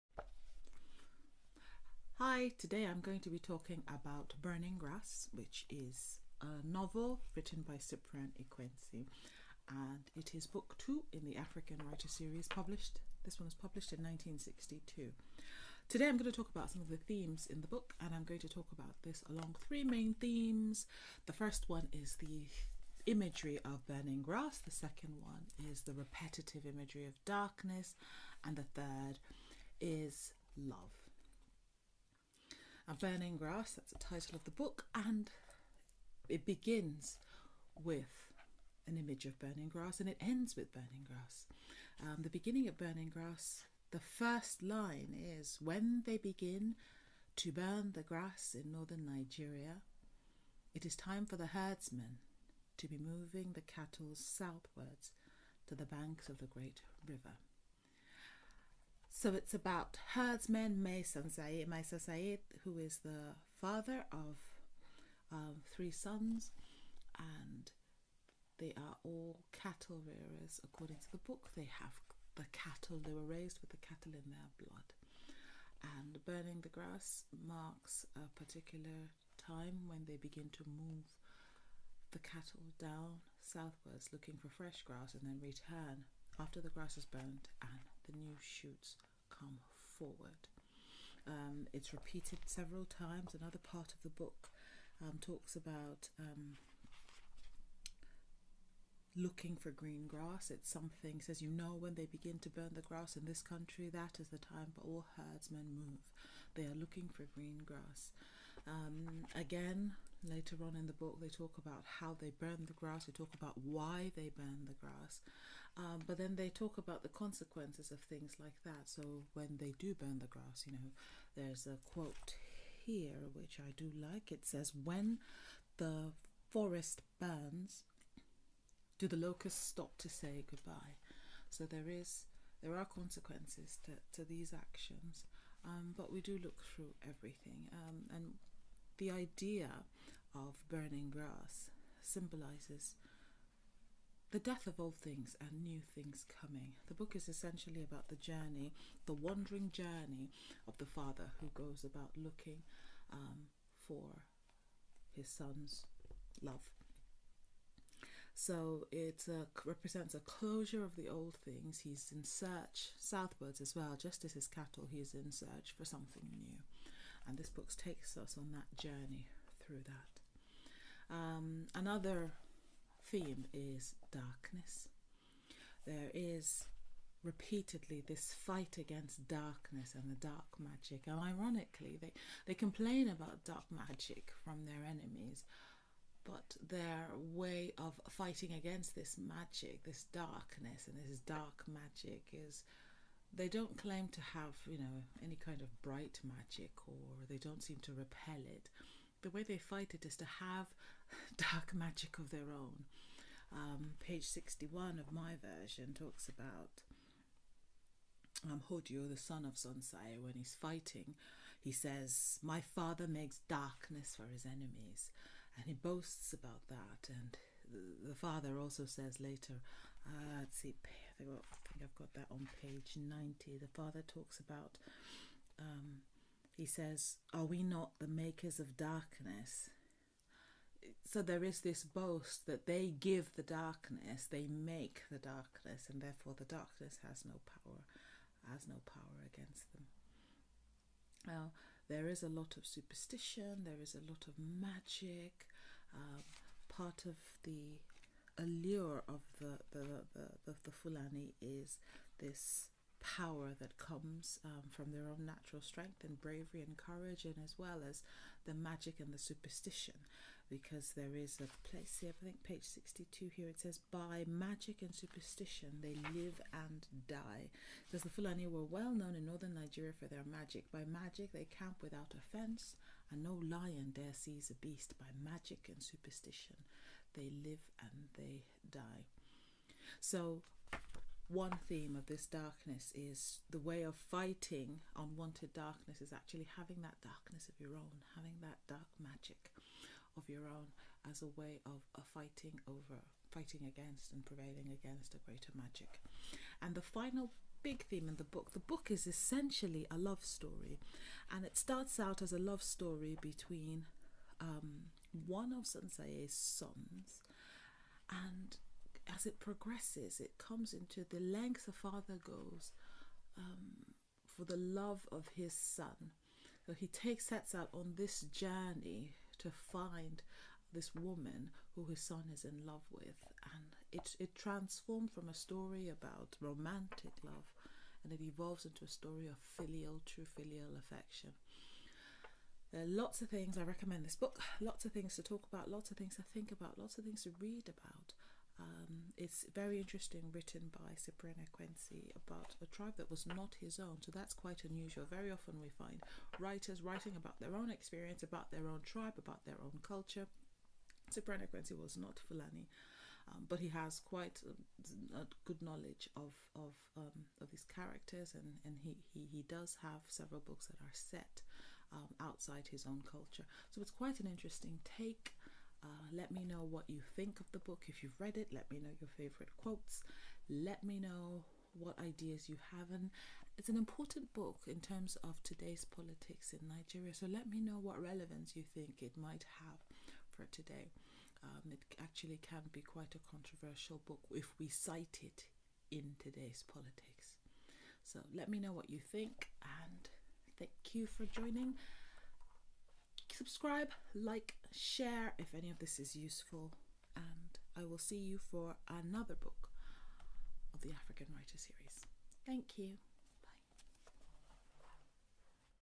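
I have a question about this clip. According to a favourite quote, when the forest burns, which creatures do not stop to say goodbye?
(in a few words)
locusts.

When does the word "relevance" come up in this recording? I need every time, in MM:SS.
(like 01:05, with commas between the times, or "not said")
06:18.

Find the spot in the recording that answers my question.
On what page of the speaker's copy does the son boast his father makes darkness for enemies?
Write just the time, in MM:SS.
03:24.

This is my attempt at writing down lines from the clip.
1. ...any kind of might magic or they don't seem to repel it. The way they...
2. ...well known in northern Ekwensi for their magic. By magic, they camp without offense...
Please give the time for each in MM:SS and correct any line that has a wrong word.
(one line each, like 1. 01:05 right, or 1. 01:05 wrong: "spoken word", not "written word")
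1. 03:15 wrong: "bright", not "might"
2. 04:28 wrong: "Nigeria", not "Ekwensi".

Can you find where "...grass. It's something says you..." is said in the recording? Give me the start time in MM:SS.
01:40.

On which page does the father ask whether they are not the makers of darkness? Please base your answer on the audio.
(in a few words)
90.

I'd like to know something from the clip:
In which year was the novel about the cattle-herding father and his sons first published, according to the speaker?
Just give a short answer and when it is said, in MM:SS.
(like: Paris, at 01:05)
1962, at 00:13.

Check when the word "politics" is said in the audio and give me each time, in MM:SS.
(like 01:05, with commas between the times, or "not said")
06:15, 06:26.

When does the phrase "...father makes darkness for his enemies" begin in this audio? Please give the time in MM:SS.
03:32.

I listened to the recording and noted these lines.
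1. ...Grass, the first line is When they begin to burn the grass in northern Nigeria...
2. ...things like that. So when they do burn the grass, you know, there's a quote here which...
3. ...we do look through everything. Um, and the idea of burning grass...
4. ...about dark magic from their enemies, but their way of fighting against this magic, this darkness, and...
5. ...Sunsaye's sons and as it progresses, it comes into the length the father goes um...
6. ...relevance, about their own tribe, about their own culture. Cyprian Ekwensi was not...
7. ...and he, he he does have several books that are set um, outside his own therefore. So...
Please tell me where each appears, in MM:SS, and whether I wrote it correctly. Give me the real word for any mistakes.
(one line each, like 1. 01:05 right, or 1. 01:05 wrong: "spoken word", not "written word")
1. 00:43 right
2. 01:58 right
3. 02:16 right
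4. 03:03 right
5. 05:05 right
6. 05:47 wrong: "experience", not "relevance"
7. 05:58 wrong: "culture", not "therefore".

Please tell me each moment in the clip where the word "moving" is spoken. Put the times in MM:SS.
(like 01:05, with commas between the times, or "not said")
00:52.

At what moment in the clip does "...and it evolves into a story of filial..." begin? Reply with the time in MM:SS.
05:28.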